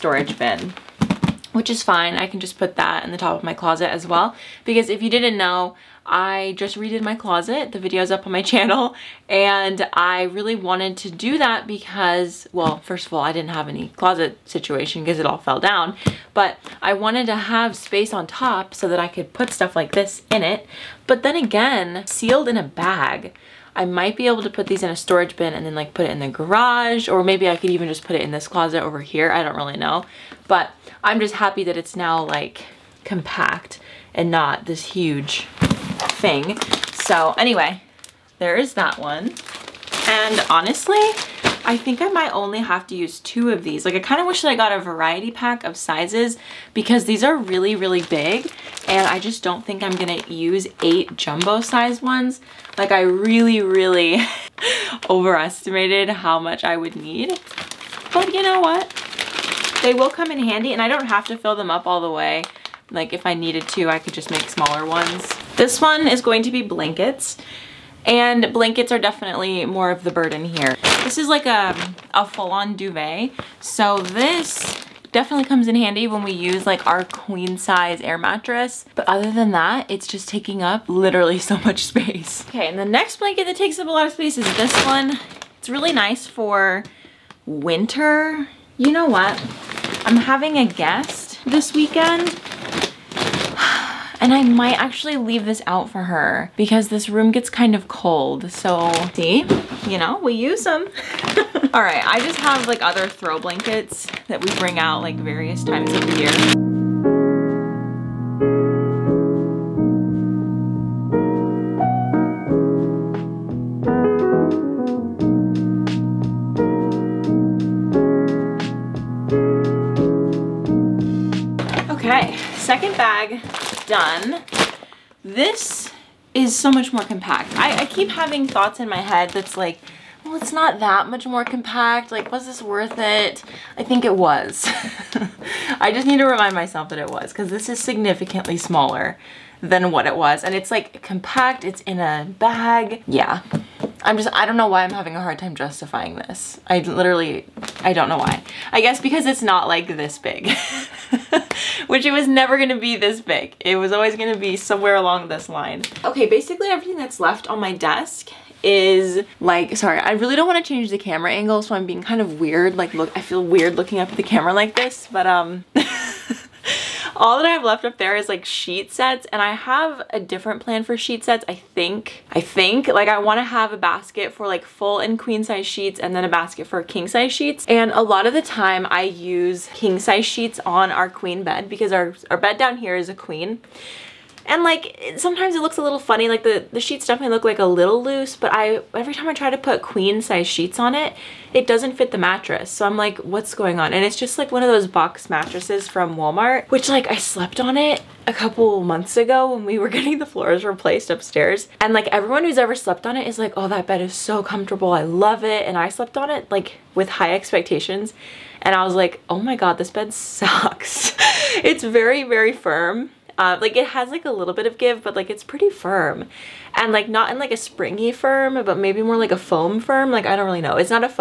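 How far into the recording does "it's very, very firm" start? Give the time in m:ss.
3:31.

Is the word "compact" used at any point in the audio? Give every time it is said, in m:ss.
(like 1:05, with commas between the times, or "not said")
0:33, 2:07, 2:11, 2:21.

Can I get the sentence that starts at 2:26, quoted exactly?
I literally, I don't know why.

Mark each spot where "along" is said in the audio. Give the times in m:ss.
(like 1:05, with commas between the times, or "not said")
2:34.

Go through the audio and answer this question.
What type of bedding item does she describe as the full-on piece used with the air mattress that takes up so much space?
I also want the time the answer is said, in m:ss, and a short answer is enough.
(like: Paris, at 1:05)
duvet, at 1:12.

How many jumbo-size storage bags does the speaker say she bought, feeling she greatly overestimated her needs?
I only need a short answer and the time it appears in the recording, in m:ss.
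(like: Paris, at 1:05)
8, at 0:50.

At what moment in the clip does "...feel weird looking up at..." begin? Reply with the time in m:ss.
2:43.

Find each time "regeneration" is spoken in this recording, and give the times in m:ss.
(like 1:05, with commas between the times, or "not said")
not said.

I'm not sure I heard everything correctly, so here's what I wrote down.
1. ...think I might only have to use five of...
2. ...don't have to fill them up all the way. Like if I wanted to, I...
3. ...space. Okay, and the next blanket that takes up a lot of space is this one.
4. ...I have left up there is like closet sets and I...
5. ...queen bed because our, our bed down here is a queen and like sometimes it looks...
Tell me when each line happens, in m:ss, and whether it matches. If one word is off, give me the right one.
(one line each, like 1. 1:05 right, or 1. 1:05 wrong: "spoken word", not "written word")
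1. 0:41 wrong: "two", not "five"
2. 1:00 wrong: "needed", not "wanted"
3. 1:21 right
4. 2:47 wrong: "sheet", not "closet"
5. 3:01 right.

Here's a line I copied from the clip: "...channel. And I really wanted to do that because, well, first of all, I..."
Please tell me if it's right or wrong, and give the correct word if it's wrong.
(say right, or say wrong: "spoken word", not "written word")
right.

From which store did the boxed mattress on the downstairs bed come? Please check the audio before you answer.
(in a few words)
Walmart.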